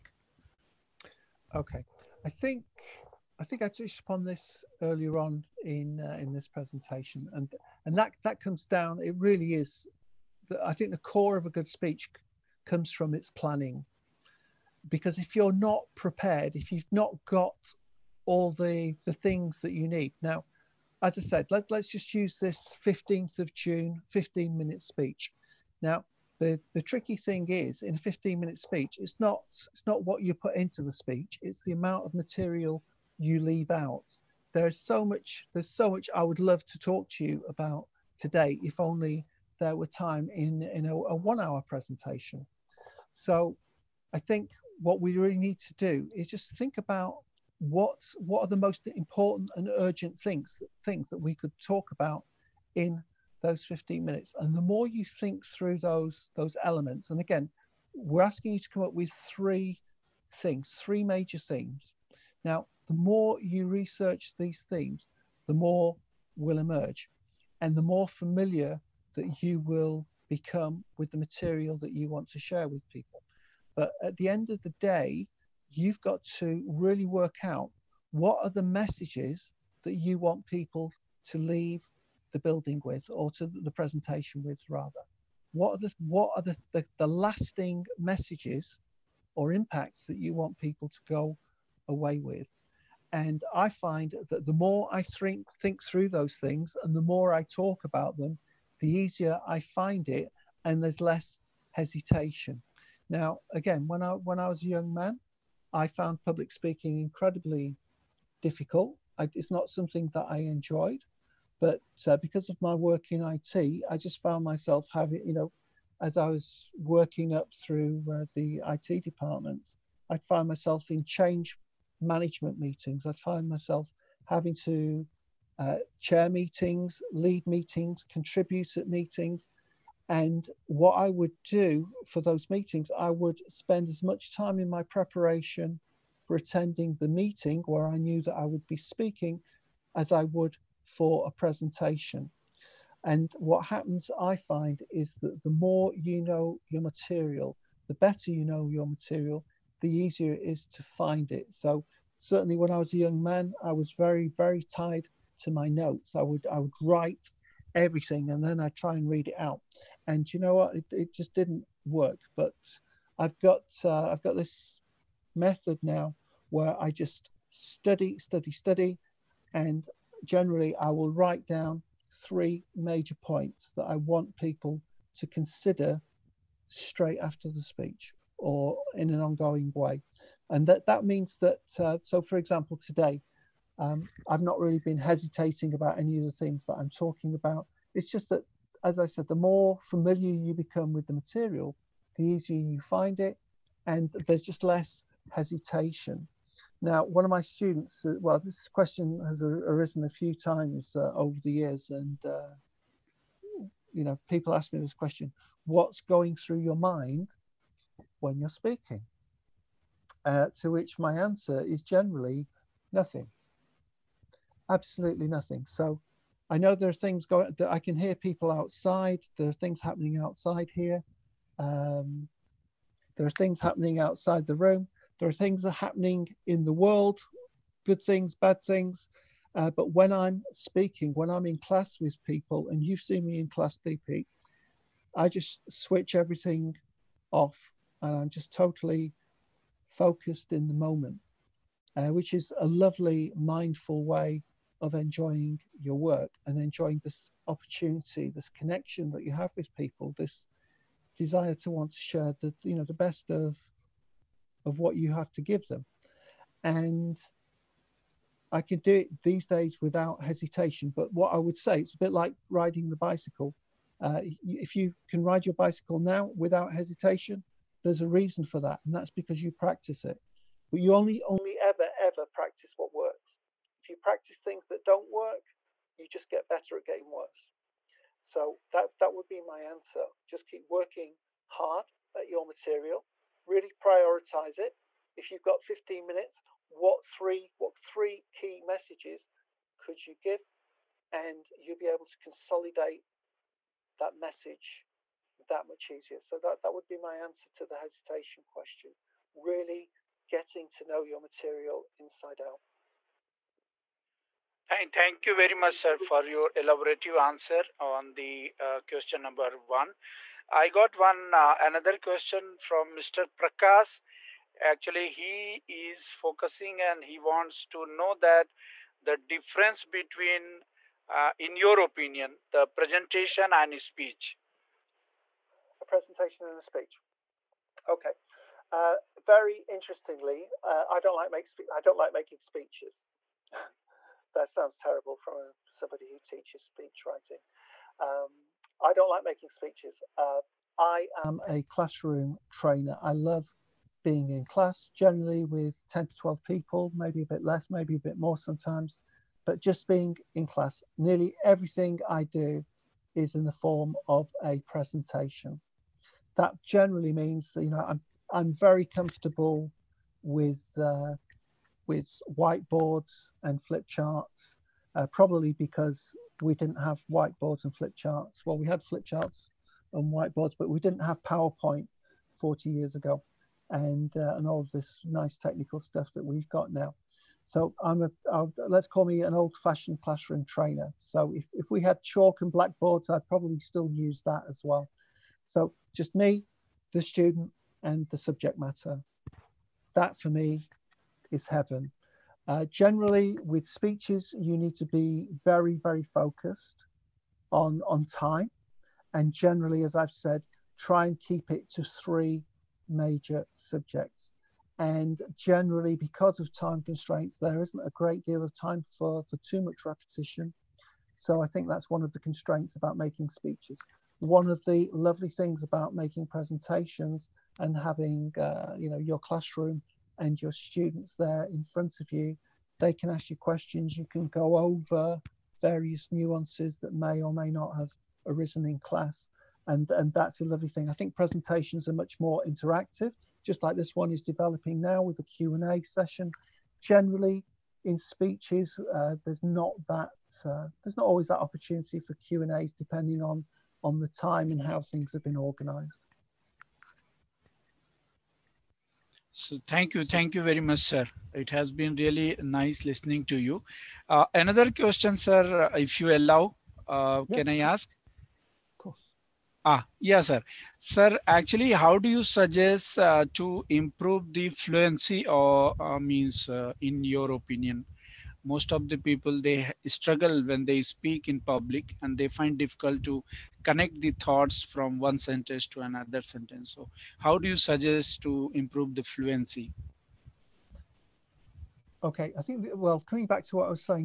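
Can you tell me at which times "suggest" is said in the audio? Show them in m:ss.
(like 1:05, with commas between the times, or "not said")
7:42, 7:57.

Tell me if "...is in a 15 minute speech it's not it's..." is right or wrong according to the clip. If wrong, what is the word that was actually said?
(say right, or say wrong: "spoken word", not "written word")
right.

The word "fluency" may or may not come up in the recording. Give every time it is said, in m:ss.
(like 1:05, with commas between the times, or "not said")
7:44, 7:59.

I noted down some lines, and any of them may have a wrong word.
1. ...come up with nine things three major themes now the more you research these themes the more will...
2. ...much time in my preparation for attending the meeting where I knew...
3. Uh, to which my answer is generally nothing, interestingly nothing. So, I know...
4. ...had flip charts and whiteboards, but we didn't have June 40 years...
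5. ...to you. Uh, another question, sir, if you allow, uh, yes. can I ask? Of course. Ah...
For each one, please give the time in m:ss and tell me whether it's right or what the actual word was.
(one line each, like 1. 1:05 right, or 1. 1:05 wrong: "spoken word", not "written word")
1. 0:58 wrong: "three", not "nine"
2. 2:14 right
3. 3:30 wrong: "absolutely", not "interestingly"
4. 6:08 wrong: "PowerPoint", not "June"
5. 7:33 right.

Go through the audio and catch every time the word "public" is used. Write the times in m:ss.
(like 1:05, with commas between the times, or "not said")
1:46, 7:51.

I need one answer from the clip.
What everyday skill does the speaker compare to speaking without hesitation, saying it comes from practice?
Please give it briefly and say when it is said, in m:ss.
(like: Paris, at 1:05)
riding the bicycle, at 4:22.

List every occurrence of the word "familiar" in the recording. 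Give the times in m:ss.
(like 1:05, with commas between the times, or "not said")
1:08, 3:09.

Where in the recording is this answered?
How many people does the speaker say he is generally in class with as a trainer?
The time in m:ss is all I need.
5:45.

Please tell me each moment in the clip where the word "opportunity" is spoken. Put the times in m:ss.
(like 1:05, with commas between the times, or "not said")
4:07, 7:21.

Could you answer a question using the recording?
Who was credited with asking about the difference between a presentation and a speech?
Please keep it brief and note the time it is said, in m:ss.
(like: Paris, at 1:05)
Mr. Prakash, at 5:12.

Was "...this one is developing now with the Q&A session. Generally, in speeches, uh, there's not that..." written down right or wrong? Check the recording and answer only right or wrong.
right.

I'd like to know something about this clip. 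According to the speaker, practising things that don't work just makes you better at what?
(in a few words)
getting worse.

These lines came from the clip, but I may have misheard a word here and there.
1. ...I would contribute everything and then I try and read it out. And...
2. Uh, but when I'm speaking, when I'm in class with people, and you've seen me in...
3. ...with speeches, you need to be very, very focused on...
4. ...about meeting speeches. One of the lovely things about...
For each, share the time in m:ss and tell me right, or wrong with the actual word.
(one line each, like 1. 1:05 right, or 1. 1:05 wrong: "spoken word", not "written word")
1. 2:36 wrong: "write", not "contribute"
2. 3:49 right
3. 6:33 right
4. 6:52 wrong: "making", not "meeting".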